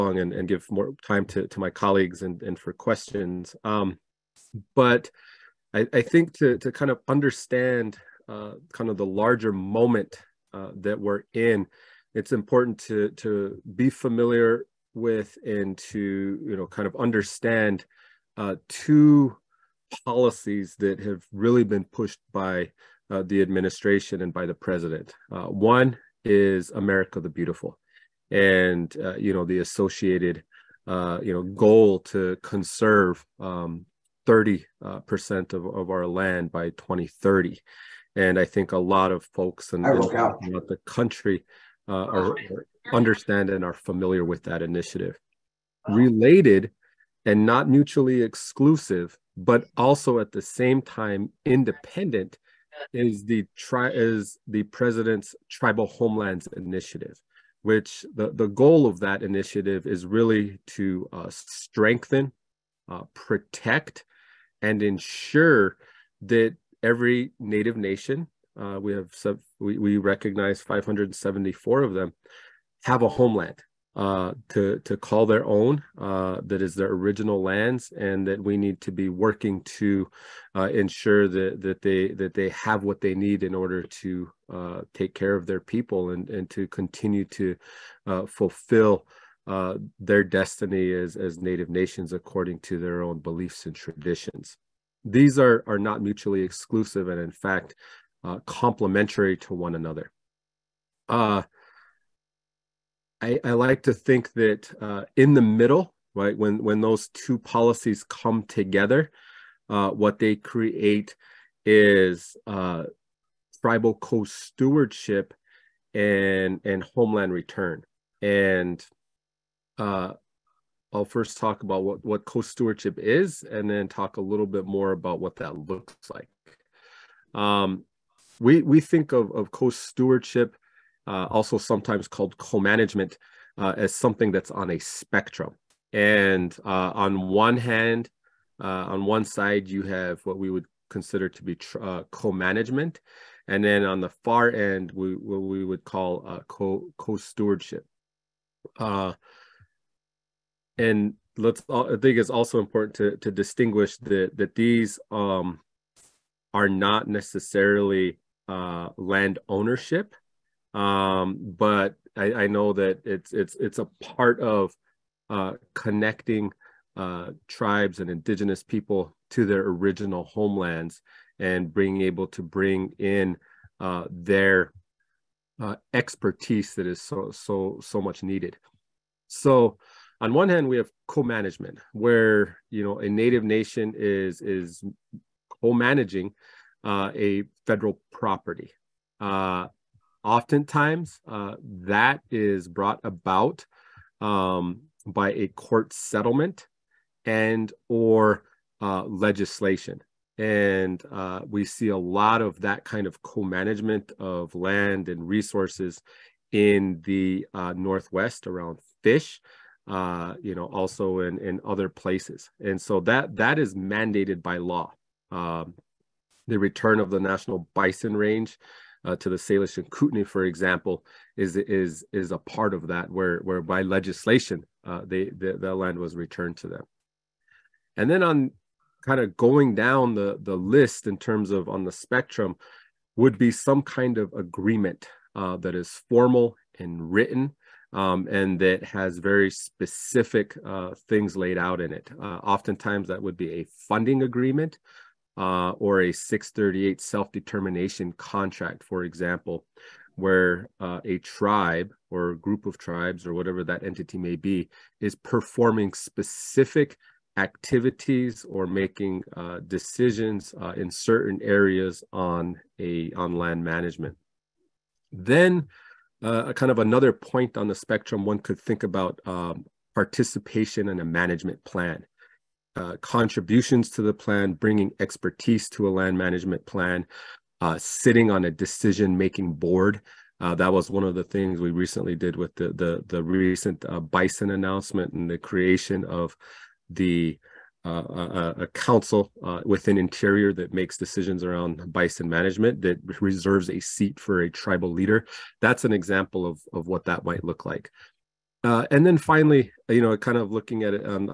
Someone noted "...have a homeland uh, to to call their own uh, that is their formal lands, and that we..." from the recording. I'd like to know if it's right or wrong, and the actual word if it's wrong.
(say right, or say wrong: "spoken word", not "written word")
wrong: "original", not "formal".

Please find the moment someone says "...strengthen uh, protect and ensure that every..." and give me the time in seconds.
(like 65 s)
61 s.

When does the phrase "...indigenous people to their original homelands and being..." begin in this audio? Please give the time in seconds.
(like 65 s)
168 s.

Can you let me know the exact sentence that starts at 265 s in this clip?
Then, uh, kind of another point on the spectrum, one could think about um, participation in a management plan.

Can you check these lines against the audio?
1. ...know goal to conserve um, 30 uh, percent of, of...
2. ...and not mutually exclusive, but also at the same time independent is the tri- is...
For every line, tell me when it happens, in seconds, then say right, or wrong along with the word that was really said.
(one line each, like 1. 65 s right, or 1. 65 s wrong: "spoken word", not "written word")
1. 31 s right
2. 47 s right.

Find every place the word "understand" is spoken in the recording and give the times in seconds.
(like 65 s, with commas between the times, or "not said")
7 s, 16 s, 42 s.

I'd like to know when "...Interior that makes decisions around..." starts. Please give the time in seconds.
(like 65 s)
289 s.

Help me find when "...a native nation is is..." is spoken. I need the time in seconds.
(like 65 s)
182 s.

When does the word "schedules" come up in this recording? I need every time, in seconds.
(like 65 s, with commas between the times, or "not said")
not said.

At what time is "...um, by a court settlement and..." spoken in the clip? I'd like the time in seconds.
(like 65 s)
194 s.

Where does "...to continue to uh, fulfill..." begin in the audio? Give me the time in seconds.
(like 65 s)
86 s.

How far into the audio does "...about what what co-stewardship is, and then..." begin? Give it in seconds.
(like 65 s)
121 s.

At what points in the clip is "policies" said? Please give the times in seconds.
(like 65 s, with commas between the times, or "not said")
20 s, 107 s.